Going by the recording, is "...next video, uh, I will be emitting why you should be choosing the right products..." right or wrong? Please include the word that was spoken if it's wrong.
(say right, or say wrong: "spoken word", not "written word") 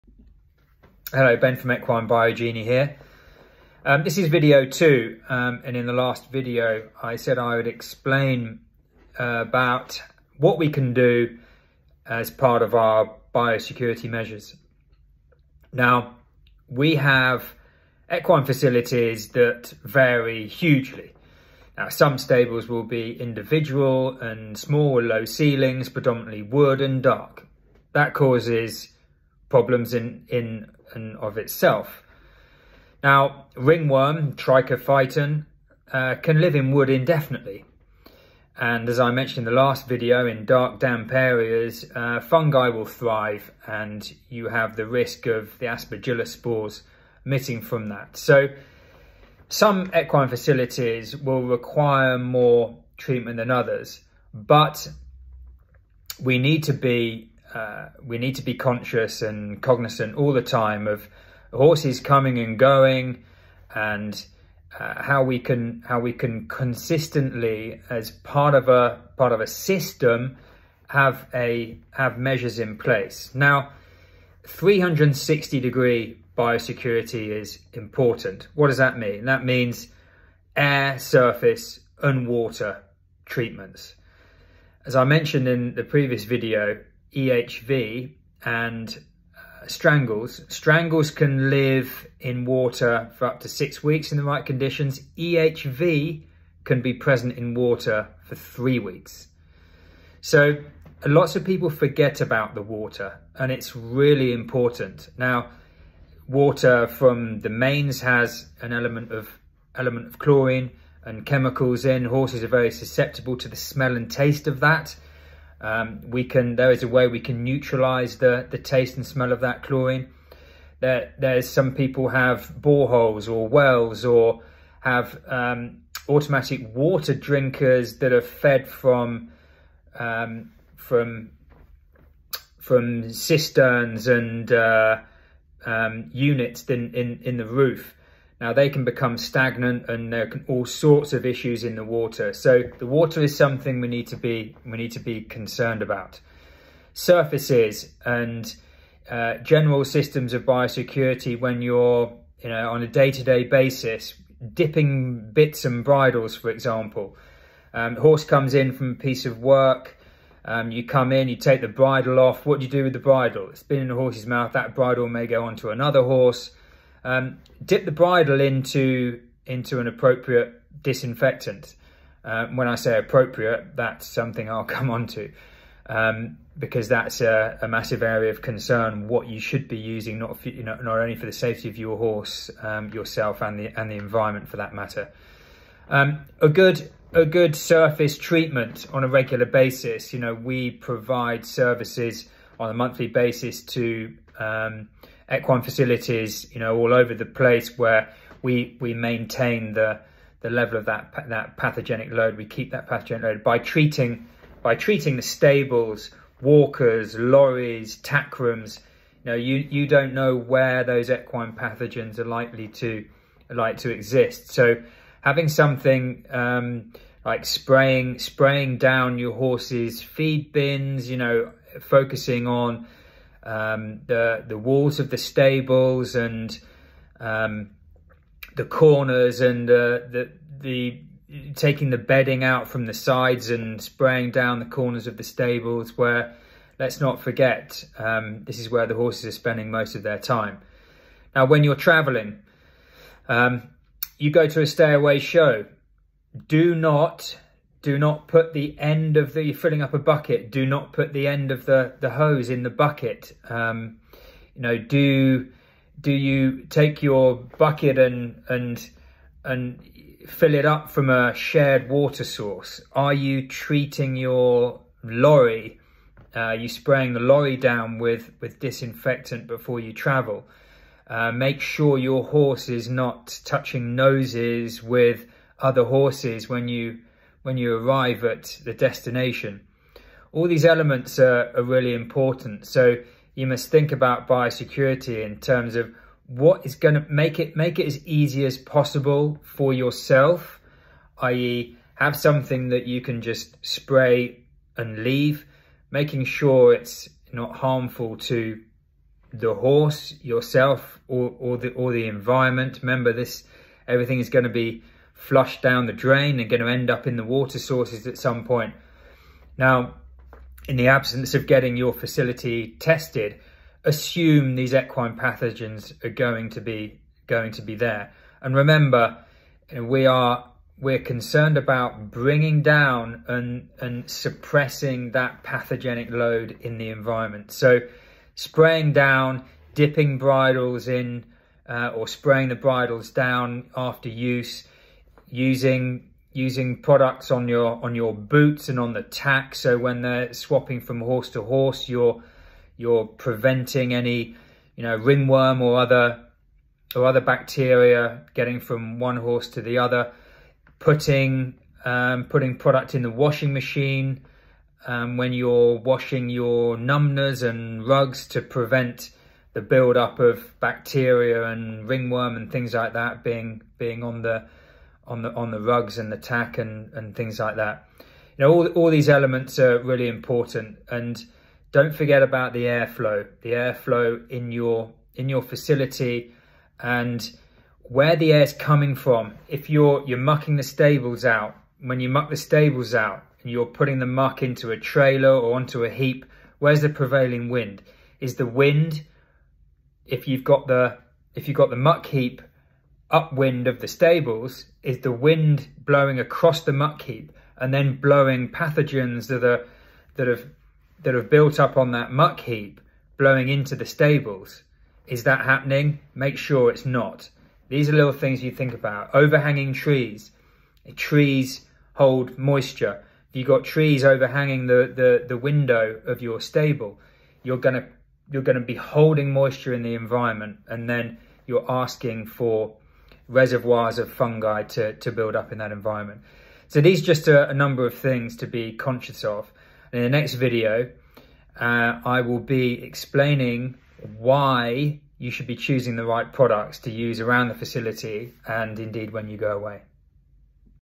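wrong: "explaining", not "emitting".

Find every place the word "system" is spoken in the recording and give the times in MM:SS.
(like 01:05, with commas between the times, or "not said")
01:09, 02:29.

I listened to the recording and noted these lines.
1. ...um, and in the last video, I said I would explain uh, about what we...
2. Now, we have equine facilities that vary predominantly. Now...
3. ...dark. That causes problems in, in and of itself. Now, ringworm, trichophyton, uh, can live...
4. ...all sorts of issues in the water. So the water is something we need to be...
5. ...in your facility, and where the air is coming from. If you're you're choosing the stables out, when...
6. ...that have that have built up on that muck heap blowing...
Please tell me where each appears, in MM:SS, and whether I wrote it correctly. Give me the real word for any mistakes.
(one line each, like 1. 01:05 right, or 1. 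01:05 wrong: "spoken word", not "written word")
1. 00:05 right
2. 00:15 wrong: "hugely", not "predominantly"
3. 00:27 right
4. 02:20 right
5. 06:15 wrong: "mucking", not "choosing"
6. 06:40 right.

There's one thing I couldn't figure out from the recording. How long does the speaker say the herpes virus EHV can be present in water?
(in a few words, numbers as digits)
3 weeks.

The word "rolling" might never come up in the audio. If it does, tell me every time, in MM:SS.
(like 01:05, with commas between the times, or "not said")
not said.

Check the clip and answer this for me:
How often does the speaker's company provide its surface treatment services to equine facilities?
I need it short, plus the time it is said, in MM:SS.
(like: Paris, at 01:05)
Monthly, at 03:12.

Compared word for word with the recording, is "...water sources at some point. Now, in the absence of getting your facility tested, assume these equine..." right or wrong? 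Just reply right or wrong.
right.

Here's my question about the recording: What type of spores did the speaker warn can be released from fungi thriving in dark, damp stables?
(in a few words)
Aspergillus.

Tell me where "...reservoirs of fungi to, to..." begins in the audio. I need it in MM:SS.
07:03.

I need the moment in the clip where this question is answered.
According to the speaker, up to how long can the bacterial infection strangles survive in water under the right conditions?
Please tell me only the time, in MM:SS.
01:33.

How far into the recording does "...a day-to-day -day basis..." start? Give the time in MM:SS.
02:32.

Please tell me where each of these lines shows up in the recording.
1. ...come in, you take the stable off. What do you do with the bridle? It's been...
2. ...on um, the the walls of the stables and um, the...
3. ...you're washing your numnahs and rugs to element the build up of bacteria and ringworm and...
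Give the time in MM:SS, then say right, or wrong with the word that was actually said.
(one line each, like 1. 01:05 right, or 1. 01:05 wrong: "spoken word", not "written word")
1. 02:40 wrong: "bridle", not "stable"
2. 03:42 right
3. 05:55 wrong: "prevent", not "element".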